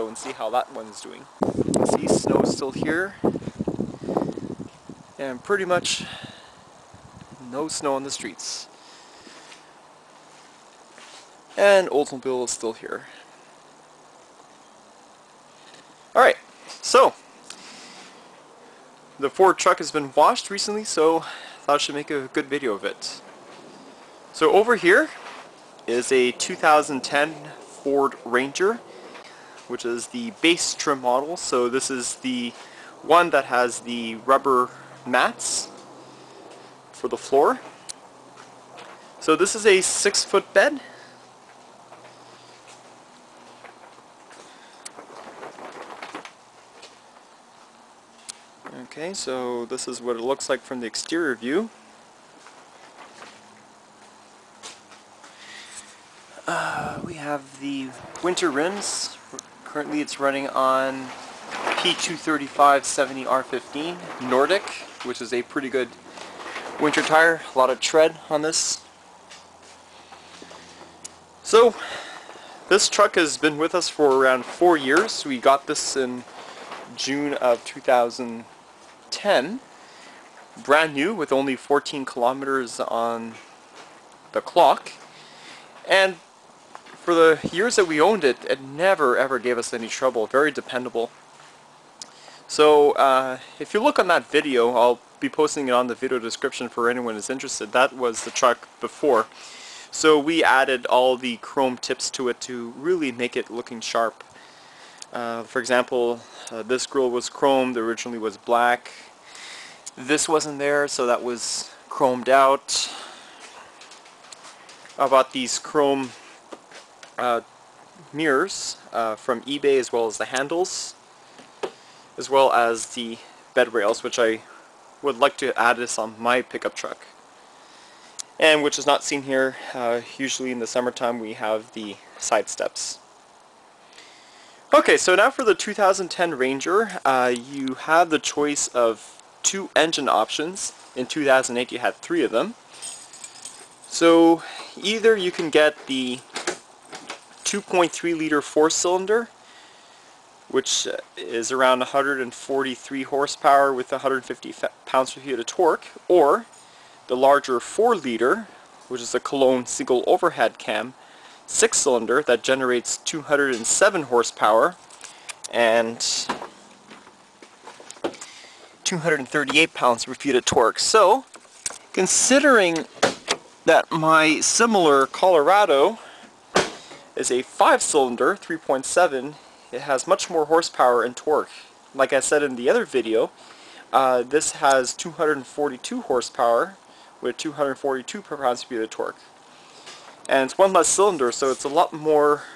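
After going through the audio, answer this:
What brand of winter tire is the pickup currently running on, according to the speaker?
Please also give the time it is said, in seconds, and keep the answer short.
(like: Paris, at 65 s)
Nordic, at 64 s.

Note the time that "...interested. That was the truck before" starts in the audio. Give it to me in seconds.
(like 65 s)
97 s.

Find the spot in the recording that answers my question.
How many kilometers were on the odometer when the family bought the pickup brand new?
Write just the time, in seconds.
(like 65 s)
81 s.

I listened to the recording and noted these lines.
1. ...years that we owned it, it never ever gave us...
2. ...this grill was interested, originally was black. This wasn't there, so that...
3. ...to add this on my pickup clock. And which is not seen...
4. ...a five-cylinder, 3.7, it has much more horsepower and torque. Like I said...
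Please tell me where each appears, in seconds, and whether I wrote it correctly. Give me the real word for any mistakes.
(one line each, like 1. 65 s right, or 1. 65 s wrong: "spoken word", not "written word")
1. 87 s right
2. 106 s wrong: "chromed", not "interested"
3. 125 s wrong: "truck", not "clock"
4. 177 s right.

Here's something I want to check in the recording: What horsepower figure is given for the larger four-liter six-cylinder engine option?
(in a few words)
207.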